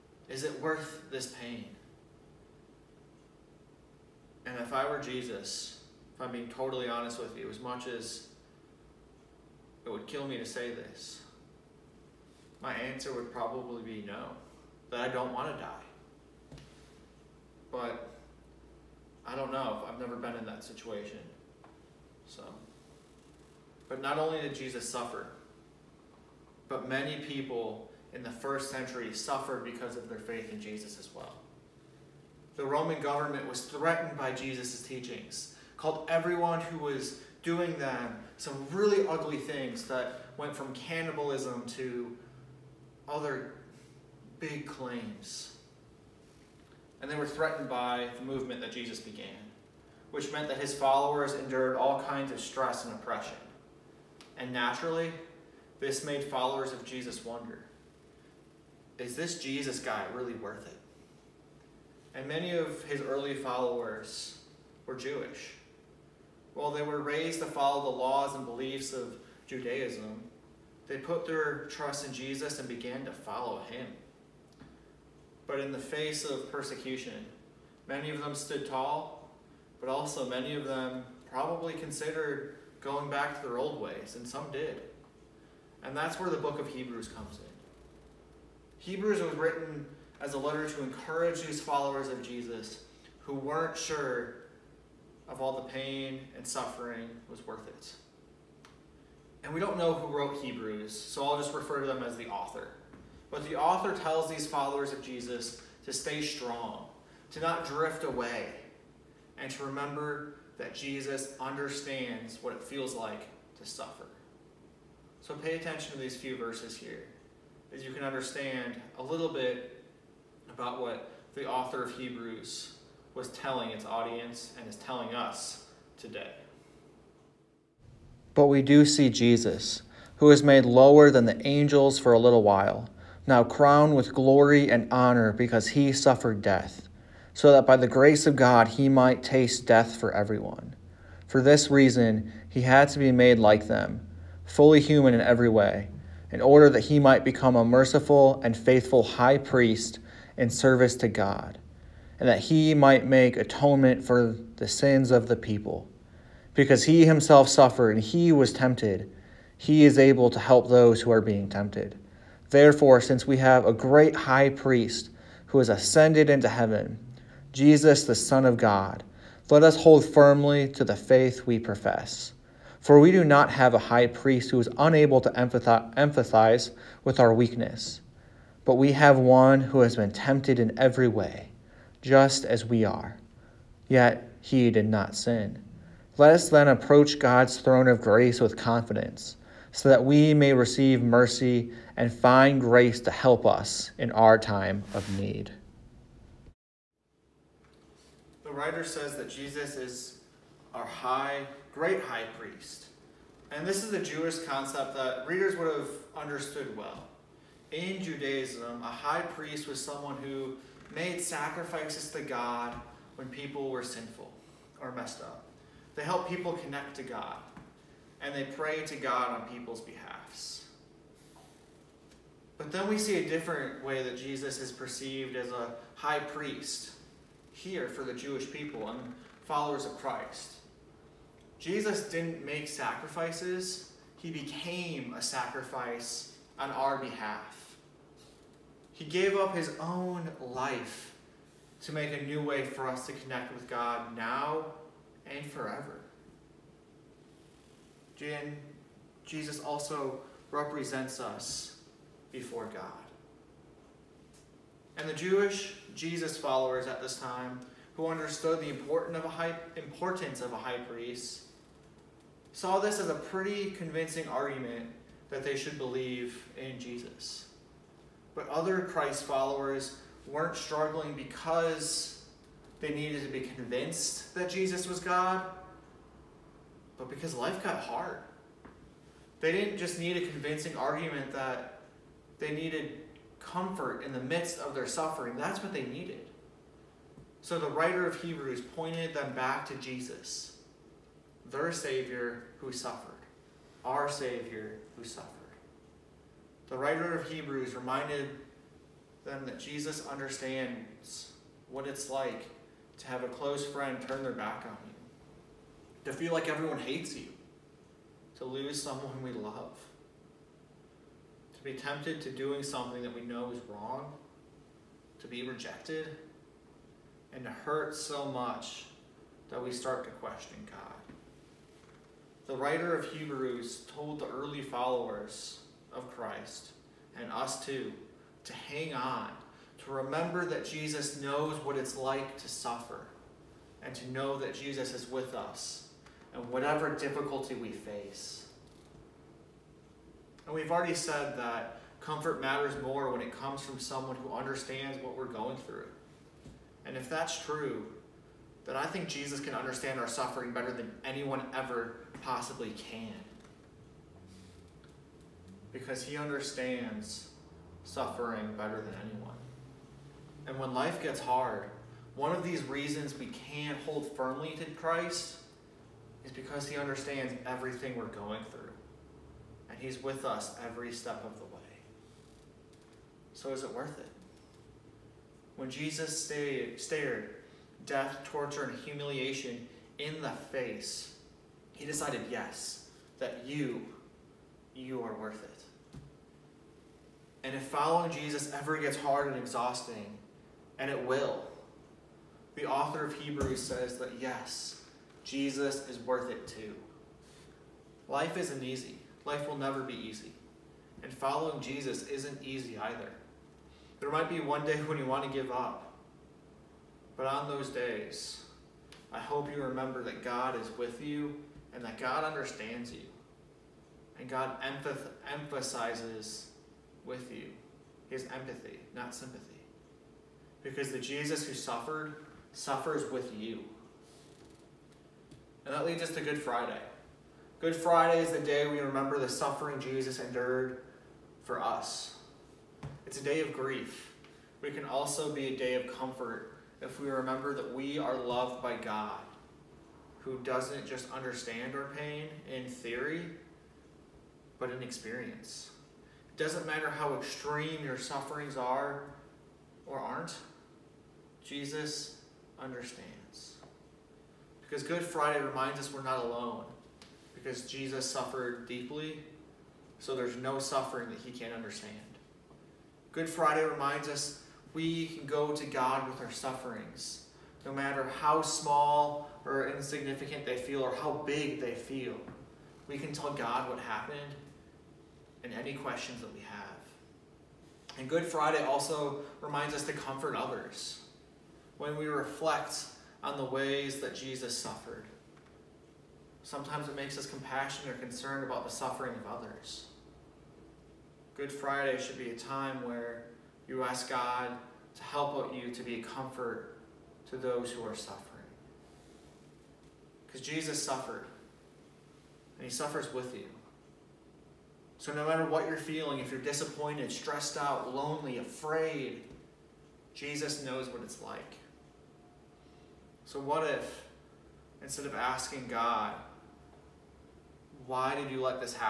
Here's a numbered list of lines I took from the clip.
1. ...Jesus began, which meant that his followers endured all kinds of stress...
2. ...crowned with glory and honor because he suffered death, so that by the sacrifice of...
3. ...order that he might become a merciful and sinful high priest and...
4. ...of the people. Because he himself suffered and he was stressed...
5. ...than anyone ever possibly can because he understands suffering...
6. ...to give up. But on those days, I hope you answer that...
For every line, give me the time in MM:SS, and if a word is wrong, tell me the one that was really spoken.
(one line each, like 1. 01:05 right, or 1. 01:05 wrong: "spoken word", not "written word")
1. 00:48 right
2. 02:13 wrong: "grace", not "sacrifice"
3. 02:26 wrong: "faithful", not "sinful"
4. 02:35 wrong: "tempted", not "stressed"
5. 05:50 right
6. 06:45 wrong: "remember", not "answer".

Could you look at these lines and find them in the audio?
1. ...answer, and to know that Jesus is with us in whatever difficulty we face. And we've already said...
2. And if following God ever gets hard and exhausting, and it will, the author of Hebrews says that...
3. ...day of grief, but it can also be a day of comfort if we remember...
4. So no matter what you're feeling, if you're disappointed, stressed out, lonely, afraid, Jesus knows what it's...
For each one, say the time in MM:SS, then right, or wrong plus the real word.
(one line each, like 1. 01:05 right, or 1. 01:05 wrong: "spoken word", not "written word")
1. 05:32 wrong: "suffer", not "answer"
2. 06:27 wrong: "Jesus", not "God"
3. 07:13 right
4. 08:25 right.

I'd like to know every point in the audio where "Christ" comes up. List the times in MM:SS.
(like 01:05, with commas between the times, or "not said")
03:49, 04:28, 05:26, 06:04.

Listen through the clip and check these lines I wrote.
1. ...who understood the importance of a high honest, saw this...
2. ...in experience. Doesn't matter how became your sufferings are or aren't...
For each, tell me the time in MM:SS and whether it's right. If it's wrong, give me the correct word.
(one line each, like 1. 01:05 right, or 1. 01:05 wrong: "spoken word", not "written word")
1. 04:17 wrong: "priest", not "honest"
2. 07:24 wrong: "extreme", not "became".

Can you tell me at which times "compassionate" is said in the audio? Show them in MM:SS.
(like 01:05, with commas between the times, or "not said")
08:07.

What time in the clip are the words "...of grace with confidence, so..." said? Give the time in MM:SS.
03:07.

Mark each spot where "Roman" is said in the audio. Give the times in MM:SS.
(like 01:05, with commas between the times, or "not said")
00:32.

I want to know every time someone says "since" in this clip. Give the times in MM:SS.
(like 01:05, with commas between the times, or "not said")
02:42.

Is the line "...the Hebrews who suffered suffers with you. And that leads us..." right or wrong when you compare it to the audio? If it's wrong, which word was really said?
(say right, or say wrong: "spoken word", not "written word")
wrong: "Jesus", not "Hebrews".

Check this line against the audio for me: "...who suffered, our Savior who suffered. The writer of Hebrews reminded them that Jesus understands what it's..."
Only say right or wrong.
right.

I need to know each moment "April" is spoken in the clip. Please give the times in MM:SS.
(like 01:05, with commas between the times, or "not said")
not said.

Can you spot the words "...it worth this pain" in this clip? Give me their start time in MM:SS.
00:00.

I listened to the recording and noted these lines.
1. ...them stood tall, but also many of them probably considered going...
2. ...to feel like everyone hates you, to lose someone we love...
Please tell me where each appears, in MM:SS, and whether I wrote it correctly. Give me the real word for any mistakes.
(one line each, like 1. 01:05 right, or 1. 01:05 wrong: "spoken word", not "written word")
1. 01:18 right
2. 05:06 right.